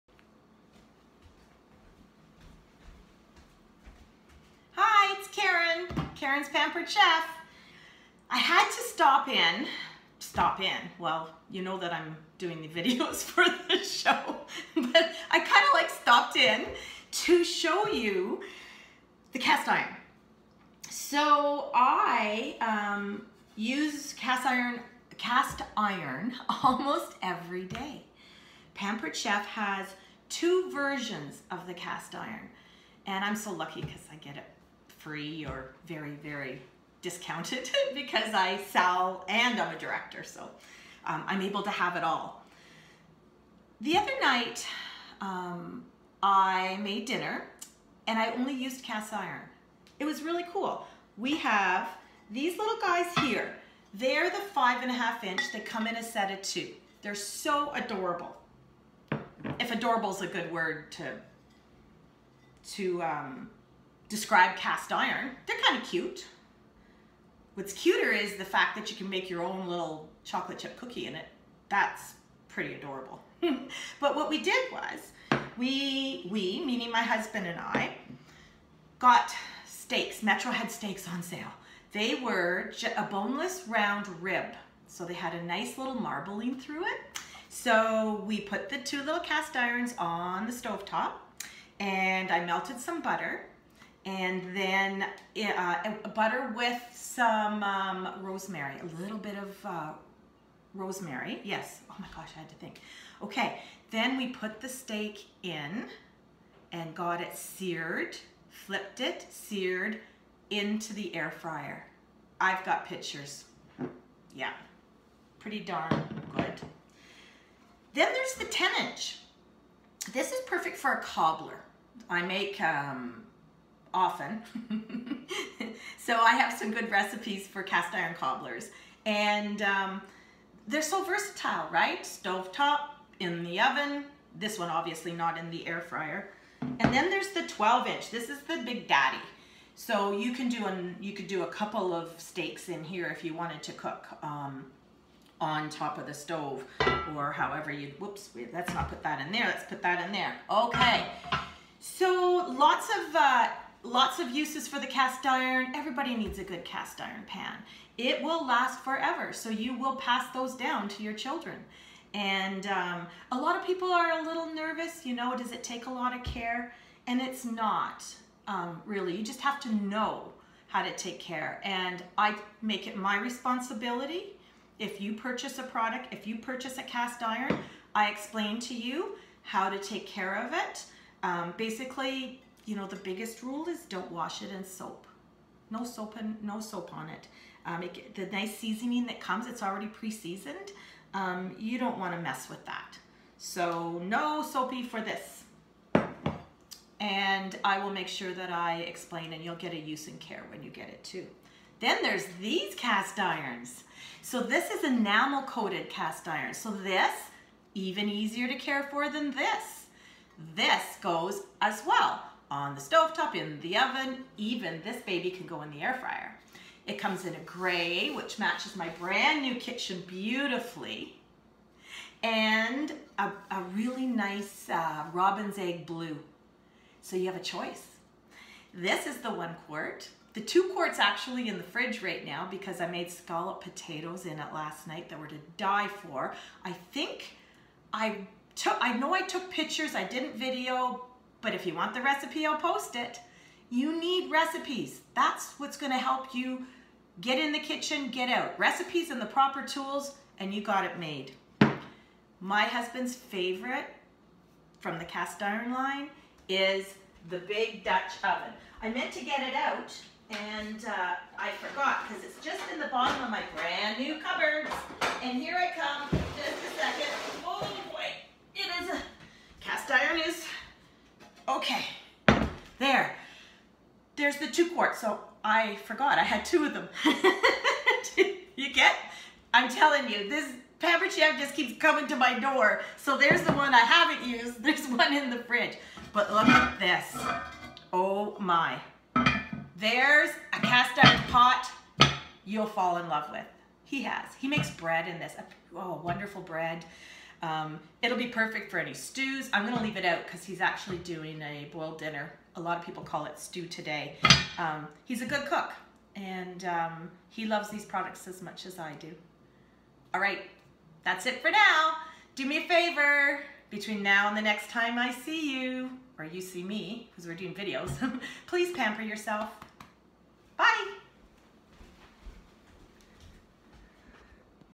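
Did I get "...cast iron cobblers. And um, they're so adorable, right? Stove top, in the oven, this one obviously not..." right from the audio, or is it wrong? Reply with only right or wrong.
wrong.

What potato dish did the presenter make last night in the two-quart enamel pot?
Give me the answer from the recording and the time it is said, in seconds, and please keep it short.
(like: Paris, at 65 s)
scallop potatoes, at 233 s.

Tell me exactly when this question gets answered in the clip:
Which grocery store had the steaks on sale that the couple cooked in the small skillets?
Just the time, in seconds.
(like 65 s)
80 s.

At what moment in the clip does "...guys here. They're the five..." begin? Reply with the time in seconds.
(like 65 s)
52 s.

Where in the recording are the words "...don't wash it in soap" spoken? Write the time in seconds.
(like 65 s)
183 s.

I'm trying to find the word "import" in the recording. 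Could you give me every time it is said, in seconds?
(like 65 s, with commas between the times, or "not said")
not said.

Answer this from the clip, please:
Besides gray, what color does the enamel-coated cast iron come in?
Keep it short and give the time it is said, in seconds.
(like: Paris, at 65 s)
robin's egg blue, at 225 s.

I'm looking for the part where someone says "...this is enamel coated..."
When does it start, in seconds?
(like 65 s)
204 s.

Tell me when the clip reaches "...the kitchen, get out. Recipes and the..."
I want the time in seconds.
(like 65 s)
247 s.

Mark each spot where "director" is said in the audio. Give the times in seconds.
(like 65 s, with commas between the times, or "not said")
39 s.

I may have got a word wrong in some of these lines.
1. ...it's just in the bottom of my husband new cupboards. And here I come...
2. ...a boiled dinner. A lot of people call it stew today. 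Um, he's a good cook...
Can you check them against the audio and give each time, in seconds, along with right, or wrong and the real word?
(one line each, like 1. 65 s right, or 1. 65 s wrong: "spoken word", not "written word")
1. 262 s wrong: "brand", not "husband"
2. 301 s right.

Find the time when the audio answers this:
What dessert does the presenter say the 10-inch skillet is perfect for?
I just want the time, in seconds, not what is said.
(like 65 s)
121 s.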